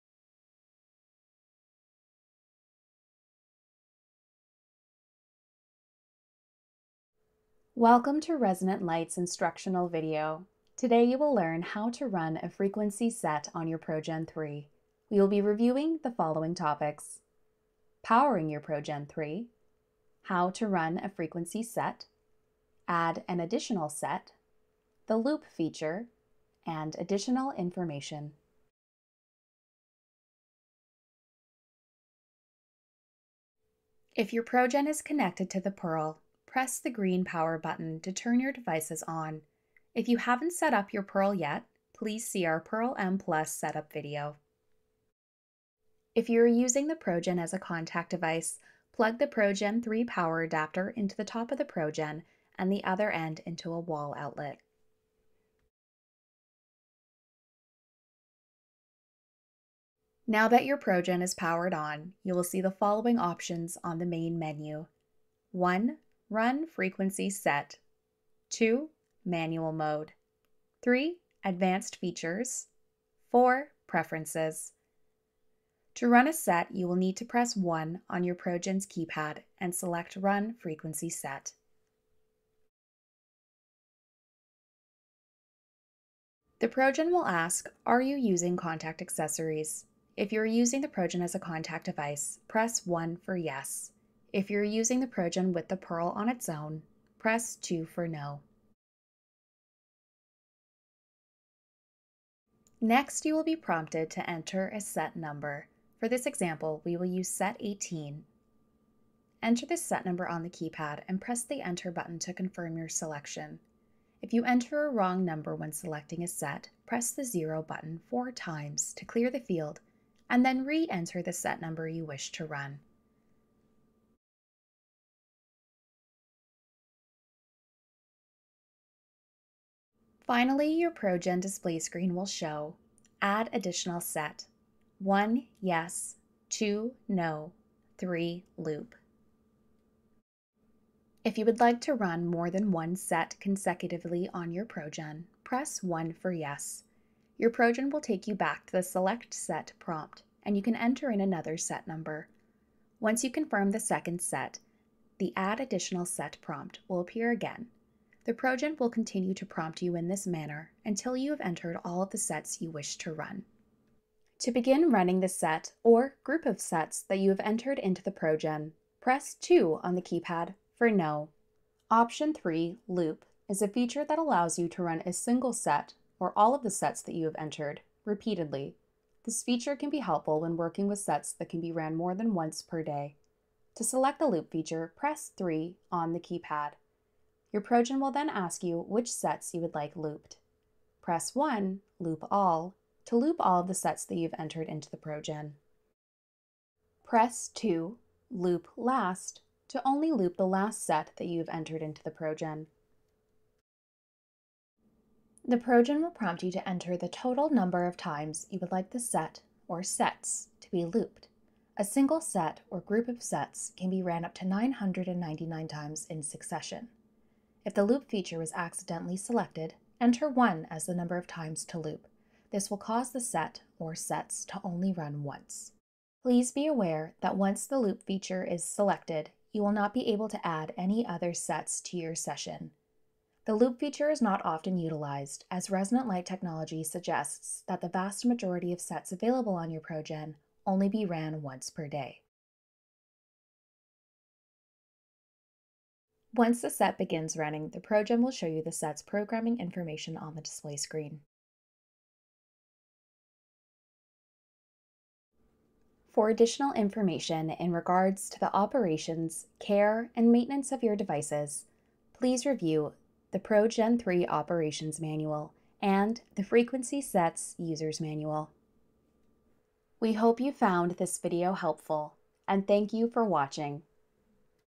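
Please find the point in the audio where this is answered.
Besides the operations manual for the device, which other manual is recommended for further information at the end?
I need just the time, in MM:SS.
04:26.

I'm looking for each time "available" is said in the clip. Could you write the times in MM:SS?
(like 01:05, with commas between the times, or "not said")
03:59.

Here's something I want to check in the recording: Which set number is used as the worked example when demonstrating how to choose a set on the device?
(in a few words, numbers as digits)
18.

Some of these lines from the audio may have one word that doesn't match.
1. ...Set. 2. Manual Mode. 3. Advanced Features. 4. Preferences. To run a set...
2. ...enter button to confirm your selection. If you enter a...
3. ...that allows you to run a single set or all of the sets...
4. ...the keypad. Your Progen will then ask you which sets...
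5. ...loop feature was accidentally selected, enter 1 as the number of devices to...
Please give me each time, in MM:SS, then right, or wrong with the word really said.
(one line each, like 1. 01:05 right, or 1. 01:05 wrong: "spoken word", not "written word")
1. 01:07 right
2. 01:51 right
3. 02:54 right
4. 03:06 right
5. 03:37 wrong: "times", not "devices".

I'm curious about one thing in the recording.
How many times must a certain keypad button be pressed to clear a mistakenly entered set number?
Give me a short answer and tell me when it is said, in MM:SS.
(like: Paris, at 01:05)
4, at 01:58.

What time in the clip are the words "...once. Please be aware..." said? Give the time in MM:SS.
03:45.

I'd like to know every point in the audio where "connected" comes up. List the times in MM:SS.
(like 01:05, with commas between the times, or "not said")
00:35.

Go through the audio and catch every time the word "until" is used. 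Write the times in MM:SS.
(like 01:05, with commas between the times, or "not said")
02:40.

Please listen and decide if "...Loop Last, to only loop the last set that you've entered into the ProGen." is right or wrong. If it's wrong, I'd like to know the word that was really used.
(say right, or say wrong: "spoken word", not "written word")
right.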